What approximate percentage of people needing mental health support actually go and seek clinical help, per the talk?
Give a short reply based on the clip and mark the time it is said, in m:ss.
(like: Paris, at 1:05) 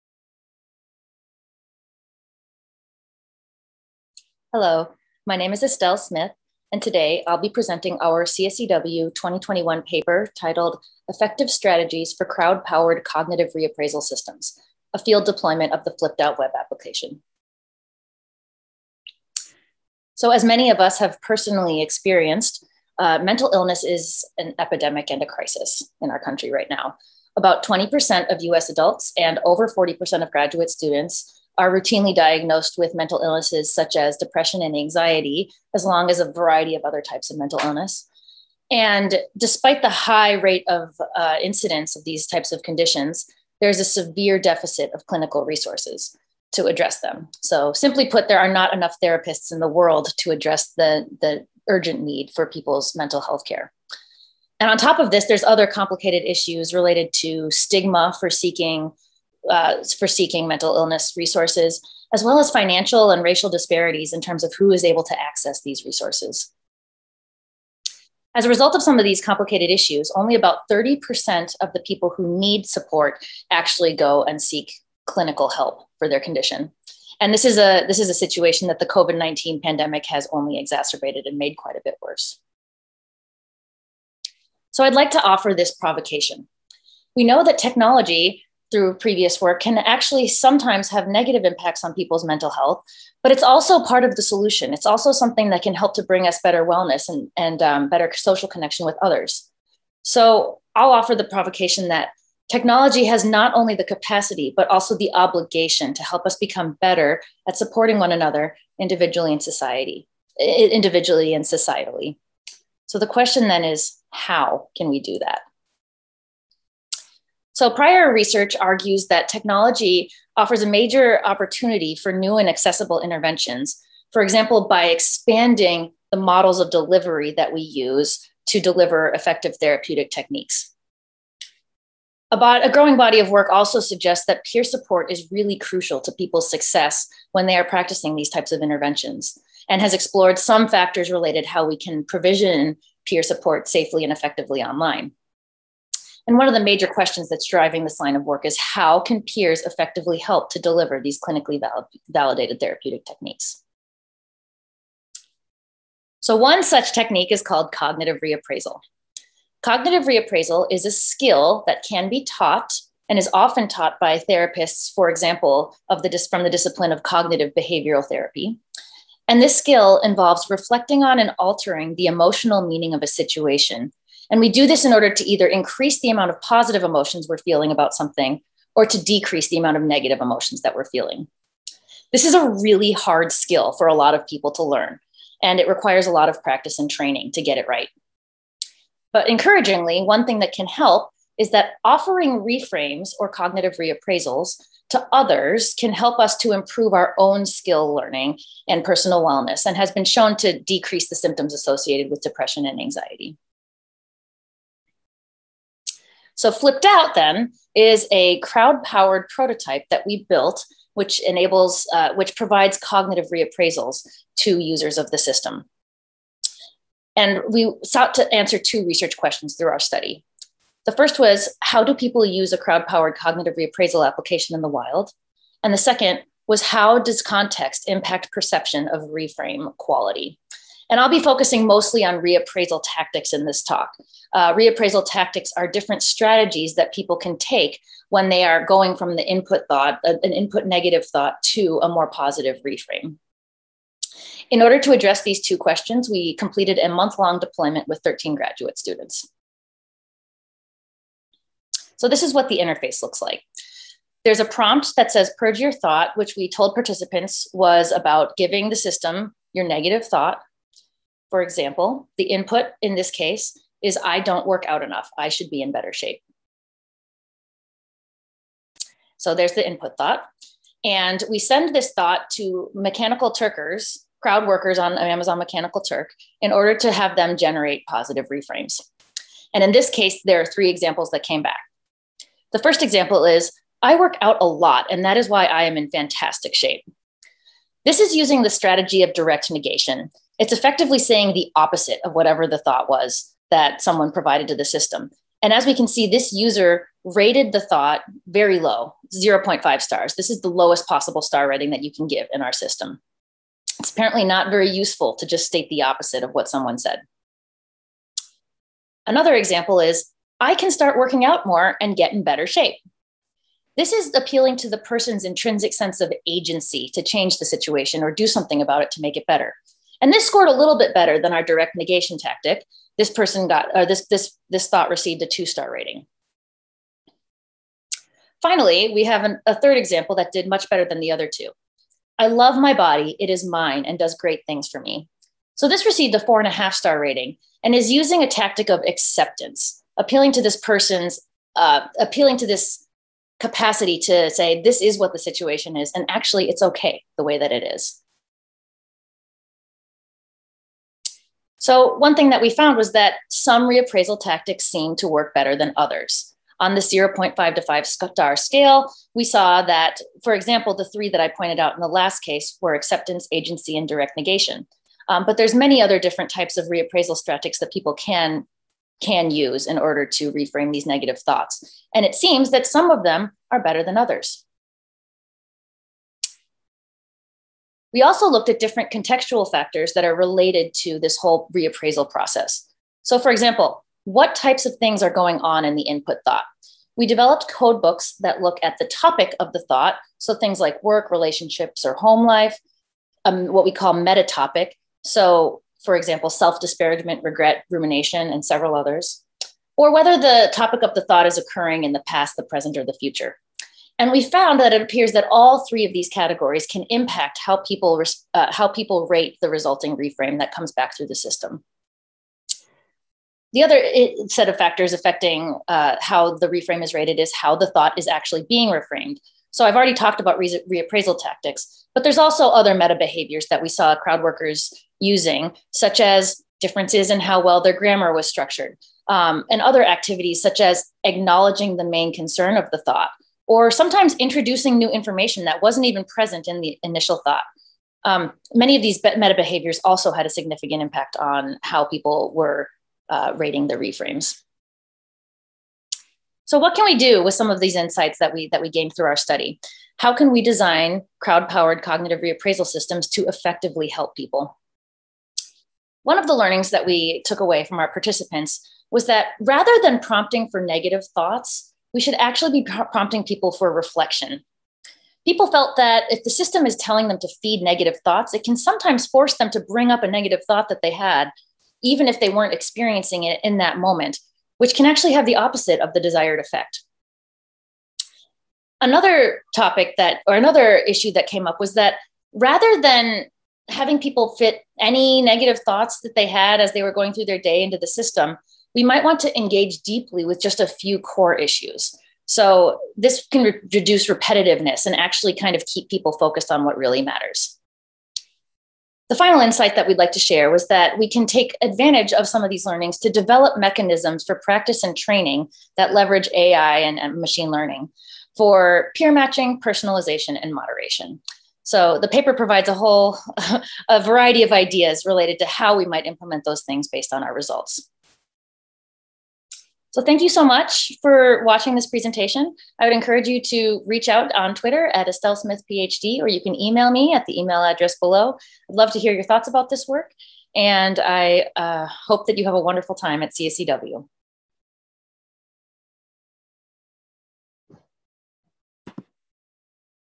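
30%, at 1:10.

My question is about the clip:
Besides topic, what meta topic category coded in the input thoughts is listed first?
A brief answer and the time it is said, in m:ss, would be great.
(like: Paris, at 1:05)
self disparagement, at 6:36.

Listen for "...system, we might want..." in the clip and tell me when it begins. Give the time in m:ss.
8:07.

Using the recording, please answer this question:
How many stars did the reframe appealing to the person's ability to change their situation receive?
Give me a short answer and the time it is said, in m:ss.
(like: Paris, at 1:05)
2, at 5:25.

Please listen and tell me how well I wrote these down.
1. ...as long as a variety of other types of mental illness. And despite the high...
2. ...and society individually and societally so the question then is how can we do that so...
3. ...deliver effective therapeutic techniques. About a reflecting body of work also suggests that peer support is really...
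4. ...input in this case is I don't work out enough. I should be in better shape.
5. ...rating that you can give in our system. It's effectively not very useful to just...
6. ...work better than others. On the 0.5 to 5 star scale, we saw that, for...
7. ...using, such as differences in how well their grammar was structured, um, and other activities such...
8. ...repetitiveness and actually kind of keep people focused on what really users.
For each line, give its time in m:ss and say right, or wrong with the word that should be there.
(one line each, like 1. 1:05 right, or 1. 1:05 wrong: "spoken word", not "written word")
1. 0:35 right
2. 1:49 right
3. 2:08 wrong: "growing", not "reflecting"
4. 4:22 right
5. 5:01 wrong: "apparently", not "effectively"
6. 5:55 right
7. 7:04 right
8. 8:14 wrong: "matters", not "users".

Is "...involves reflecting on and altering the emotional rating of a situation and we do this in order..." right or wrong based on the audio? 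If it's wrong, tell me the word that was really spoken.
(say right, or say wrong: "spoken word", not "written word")
wrong: "meaning", not "rating".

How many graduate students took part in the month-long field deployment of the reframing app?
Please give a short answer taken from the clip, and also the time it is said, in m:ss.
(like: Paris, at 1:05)
13, at 4:08.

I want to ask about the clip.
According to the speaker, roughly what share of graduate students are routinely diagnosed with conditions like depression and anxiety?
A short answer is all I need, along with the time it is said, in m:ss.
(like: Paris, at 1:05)
over 40%, at 0:29.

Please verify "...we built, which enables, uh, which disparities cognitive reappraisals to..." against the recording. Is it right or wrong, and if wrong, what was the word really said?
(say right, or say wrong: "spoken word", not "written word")
wrong: "provides", not "disparities".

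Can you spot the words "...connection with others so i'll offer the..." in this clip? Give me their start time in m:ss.
1:38.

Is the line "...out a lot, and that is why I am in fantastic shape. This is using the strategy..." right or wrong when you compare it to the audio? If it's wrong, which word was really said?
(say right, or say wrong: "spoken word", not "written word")
right.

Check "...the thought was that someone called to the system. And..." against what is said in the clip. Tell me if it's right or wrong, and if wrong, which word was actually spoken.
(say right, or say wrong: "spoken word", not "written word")
wrong: "provided", not "called".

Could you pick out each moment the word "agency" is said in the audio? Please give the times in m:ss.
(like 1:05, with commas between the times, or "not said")
5:16, 6:03.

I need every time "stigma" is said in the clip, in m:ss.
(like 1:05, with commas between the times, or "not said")
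0:57.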